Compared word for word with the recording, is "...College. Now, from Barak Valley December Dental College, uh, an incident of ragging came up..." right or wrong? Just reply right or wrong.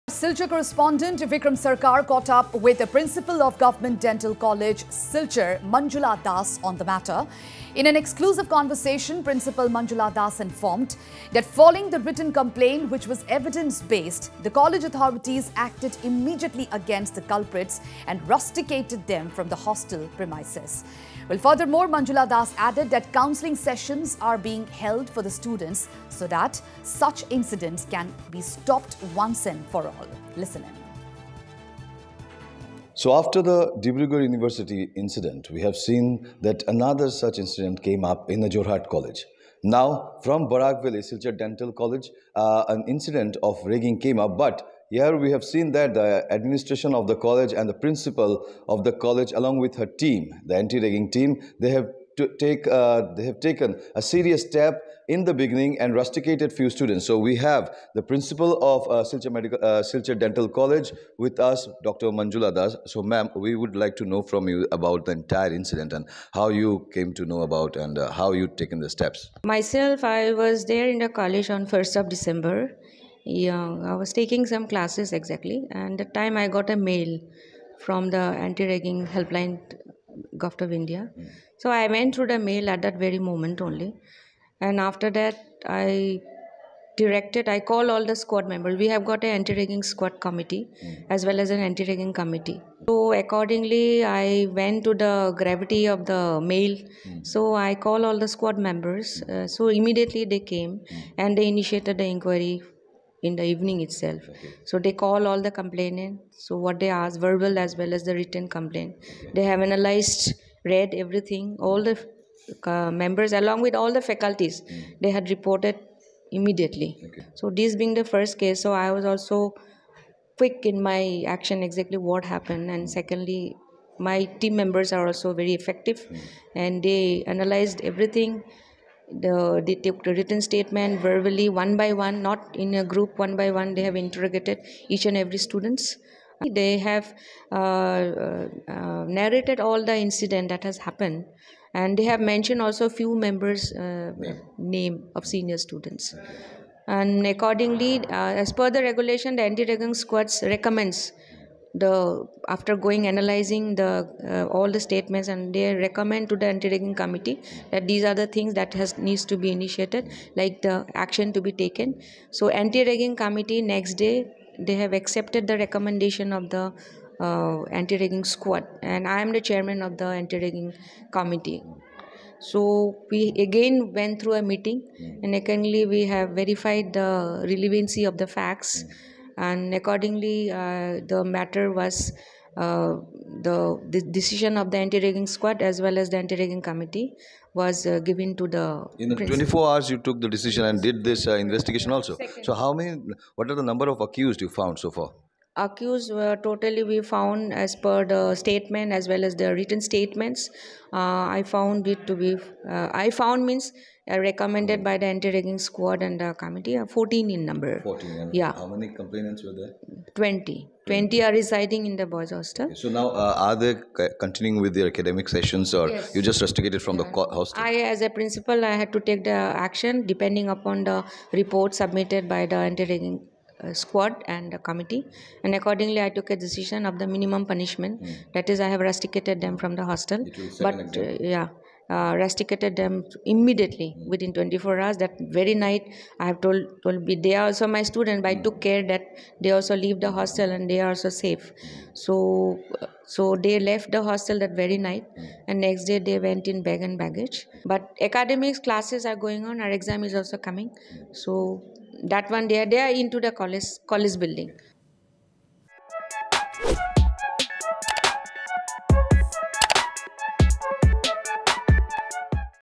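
wrong.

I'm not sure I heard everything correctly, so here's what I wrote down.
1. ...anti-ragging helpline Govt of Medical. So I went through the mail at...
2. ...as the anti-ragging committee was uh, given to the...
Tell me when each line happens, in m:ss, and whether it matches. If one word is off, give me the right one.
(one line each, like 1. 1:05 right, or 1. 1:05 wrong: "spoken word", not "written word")
1. 1:18 wrong: "India", not "Medical"
2. 3:05 right.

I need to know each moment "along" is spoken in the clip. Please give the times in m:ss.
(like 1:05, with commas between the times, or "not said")
0:49, 1:53.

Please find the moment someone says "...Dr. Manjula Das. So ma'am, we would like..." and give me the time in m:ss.
1:01.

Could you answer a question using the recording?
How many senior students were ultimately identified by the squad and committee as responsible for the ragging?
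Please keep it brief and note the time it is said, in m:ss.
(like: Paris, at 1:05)
14, at 3:26.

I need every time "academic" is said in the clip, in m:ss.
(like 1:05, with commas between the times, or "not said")
3:34, 4:08.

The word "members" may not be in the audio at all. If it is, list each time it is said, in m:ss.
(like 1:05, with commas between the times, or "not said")
1:28, 1:38, 1:52, 2:04, 2:23.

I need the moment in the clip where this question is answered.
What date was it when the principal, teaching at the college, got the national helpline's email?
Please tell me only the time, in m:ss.
1:11.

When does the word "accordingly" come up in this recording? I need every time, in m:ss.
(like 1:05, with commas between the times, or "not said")
1:33, 2:27, 2:59, 3:45.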